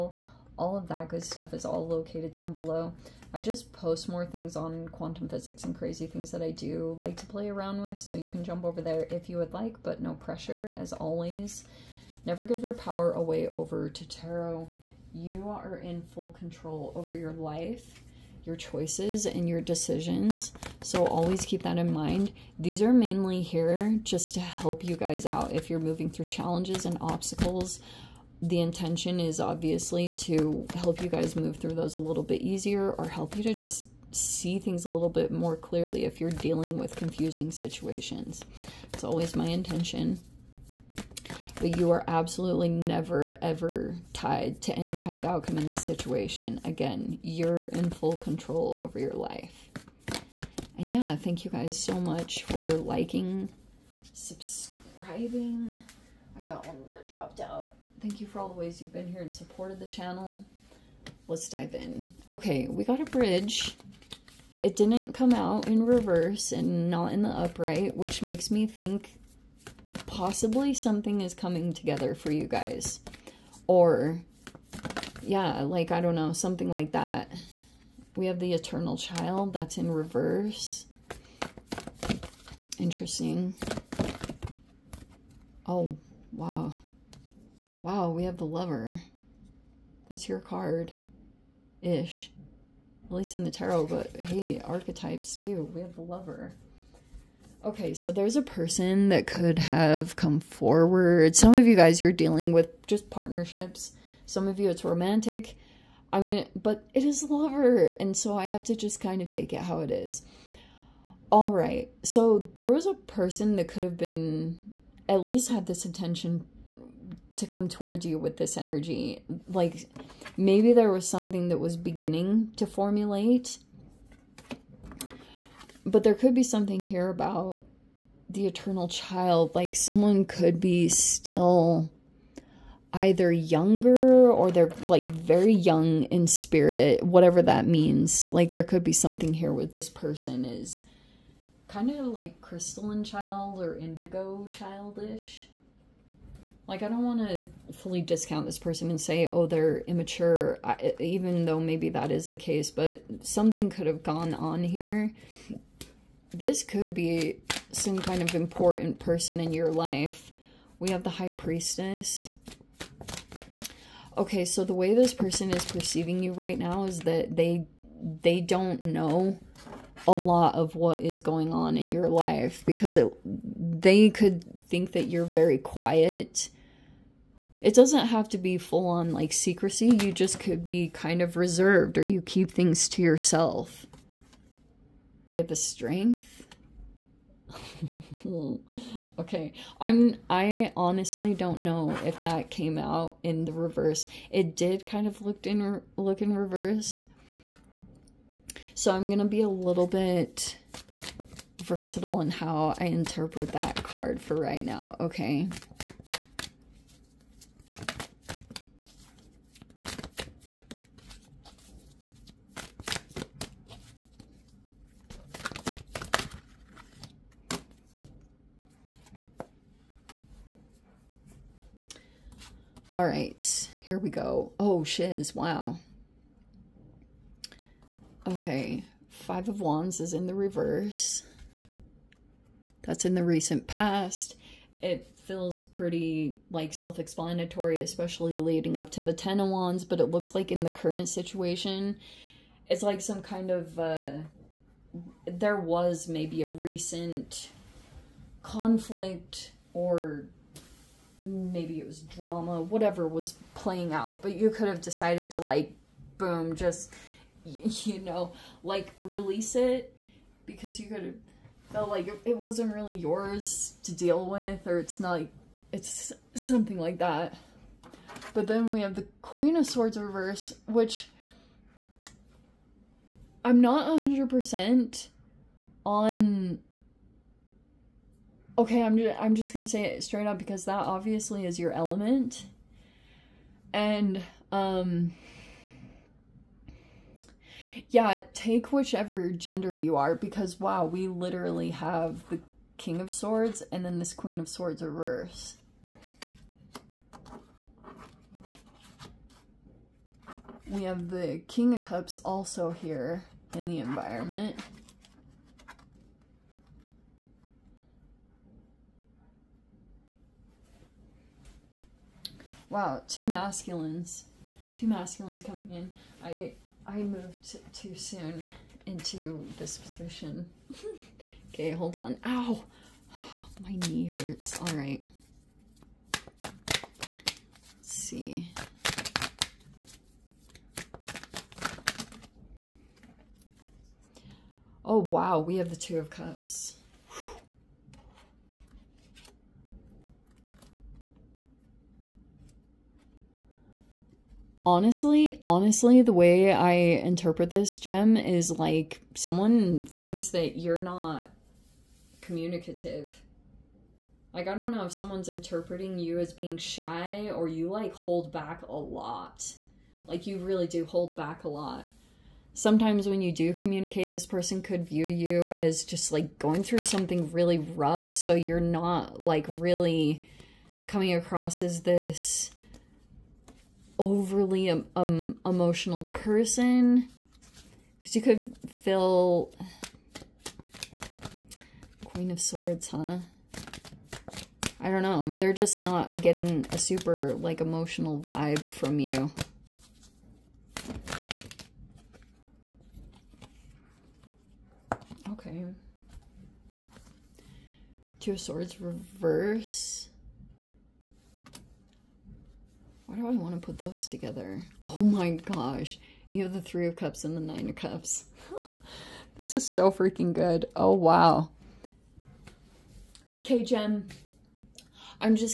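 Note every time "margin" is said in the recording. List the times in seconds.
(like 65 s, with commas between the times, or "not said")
not said.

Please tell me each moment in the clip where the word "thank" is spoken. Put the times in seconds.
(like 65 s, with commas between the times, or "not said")
51 s, 58 s.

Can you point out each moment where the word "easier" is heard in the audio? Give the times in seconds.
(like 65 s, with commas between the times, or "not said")
32 s.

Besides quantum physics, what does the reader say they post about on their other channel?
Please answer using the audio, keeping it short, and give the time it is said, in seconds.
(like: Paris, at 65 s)
Crazy things, at 5 s.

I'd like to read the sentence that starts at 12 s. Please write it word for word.
Never give your power away over to tarot.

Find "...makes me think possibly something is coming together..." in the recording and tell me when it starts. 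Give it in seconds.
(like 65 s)
68 s.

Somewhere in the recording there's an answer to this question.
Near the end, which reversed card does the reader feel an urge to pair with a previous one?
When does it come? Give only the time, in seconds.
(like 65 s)
398 s.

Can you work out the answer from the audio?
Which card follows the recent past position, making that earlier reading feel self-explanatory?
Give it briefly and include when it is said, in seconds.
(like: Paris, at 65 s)
Ten of Wands, at 239 s.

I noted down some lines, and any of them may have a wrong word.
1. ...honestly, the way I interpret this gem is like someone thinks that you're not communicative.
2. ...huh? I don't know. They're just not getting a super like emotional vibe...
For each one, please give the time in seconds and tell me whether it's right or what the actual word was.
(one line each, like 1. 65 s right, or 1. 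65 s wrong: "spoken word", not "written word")
1. 345 s right
2. 382 s right.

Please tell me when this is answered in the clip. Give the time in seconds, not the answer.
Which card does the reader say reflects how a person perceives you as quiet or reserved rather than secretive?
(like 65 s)
161 s.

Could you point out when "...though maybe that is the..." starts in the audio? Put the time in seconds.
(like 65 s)
151 s.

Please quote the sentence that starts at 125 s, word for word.
But there could be something here about the eternal child.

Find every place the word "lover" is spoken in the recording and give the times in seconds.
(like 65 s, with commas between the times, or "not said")
88 s, 96 s, 107 s.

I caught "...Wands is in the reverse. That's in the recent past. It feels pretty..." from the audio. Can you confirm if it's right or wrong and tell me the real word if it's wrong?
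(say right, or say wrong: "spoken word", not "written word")
right.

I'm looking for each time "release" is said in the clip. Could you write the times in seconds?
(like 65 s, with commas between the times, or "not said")
259 s.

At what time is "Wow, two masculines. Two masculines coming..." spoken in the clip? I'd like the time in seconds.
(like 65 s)
312 s.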